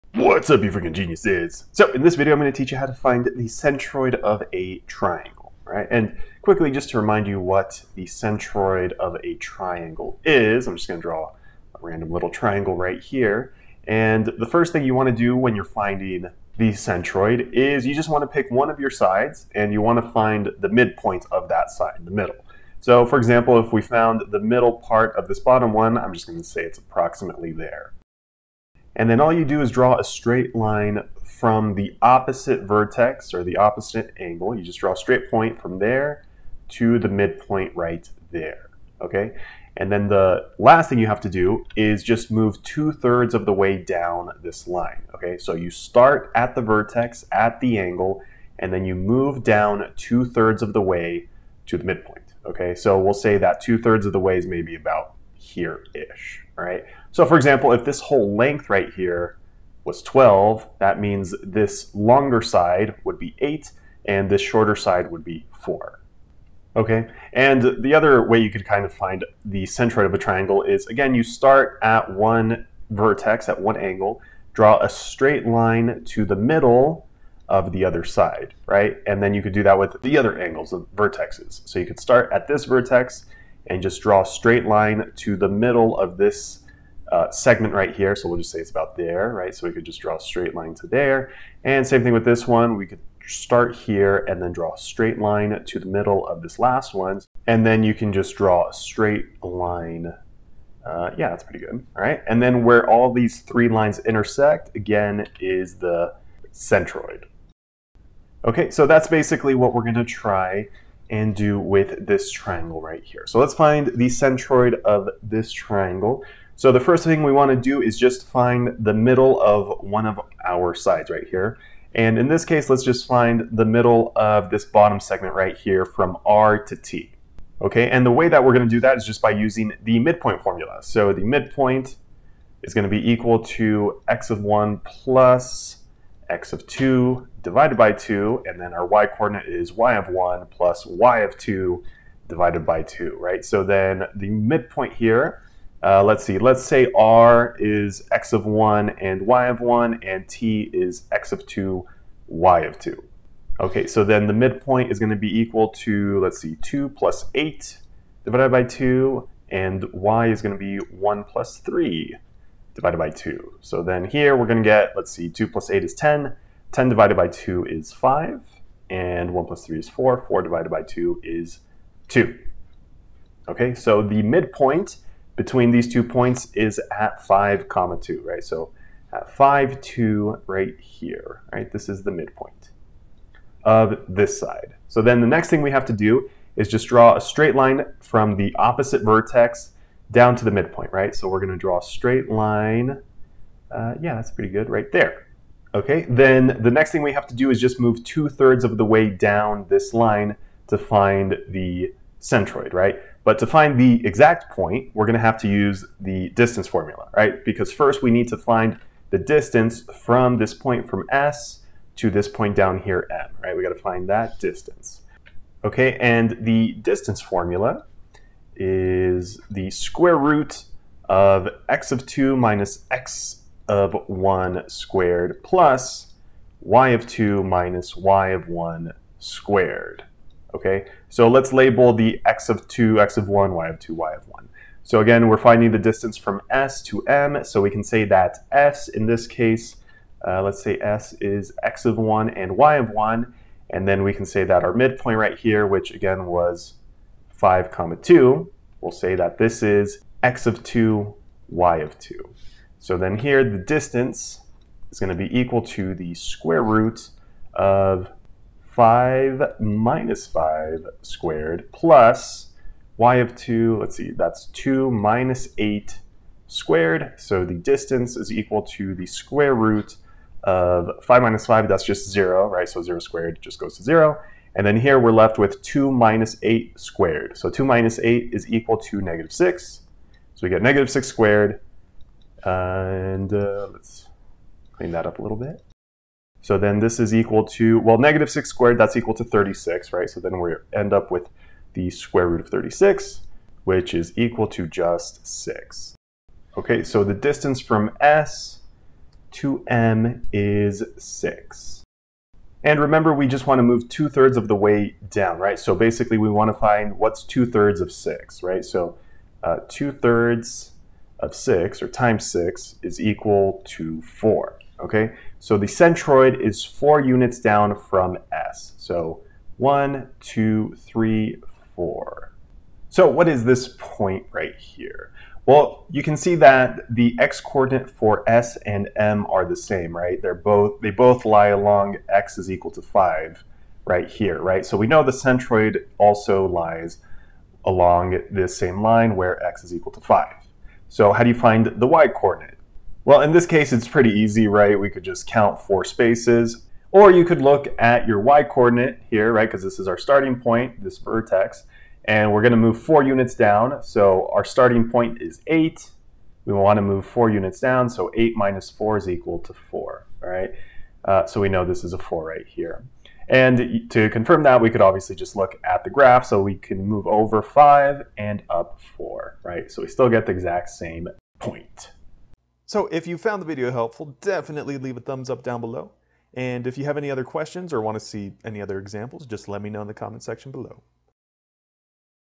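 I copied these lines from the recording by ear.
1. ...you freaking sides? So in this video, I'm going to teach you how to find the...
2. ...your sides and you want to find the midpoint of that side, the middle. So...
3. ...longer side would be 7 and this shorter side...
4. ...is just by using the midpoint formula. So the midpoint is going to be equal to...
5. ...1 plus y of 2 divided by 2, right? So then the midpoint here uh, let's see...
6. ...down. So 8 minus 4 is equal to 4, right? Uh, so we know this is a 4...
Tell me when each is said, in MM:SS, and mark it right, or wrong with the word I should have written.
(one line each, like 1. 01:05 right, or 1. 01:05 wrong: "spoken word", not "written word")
1. 00:00 wrong: "geniuses", not "sides"
2. 00:18 right
3. 01:01 wrong: "8", not "7"
4. 02:08 right
5. 02:20 right
6. 05:57 right.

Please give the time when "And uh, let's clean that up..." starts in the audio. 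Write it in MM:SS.
04:42.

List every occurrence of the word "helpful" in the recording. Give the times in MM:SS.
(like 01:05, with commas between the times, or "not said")
06:13.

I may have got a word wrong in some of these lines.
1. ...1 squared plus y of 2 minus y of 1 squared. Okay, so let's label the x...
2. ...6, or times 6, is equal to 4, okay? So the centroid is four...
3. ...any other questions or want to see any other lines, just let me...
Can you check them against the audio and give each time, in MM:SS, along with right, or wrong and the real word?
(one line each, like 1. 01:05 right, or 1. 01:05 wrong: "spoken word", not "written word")
1. 03:44 right
2. 05:11 right
3. 06:16 wrong: "examples", not "lines".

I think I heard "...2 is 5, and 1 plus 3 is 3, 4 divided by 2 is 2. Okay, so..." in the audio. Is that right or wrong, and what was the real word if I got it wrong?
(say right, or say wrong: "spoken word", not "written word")
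wrong: "4", not "3".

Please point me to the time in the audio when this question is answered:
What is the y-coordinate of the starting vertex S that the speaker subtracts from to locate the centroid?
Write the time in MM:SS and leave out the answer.
05:54.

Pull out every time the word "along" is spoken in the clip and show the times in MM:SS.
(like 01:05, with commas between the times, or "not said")
05:31, 05:37.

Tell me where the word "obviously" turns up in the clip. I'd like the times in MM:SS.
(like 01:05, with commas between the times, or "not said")
06:04.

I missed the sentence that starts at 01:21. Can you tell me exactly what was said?
So you could start at this vertex and just draw a straight line to the middle of this uh, segment right here.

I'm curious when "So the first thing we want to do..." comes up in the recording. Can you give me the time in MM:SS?
01:56.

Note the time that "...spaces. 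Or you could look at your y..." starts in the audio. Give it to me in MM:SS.
05:45.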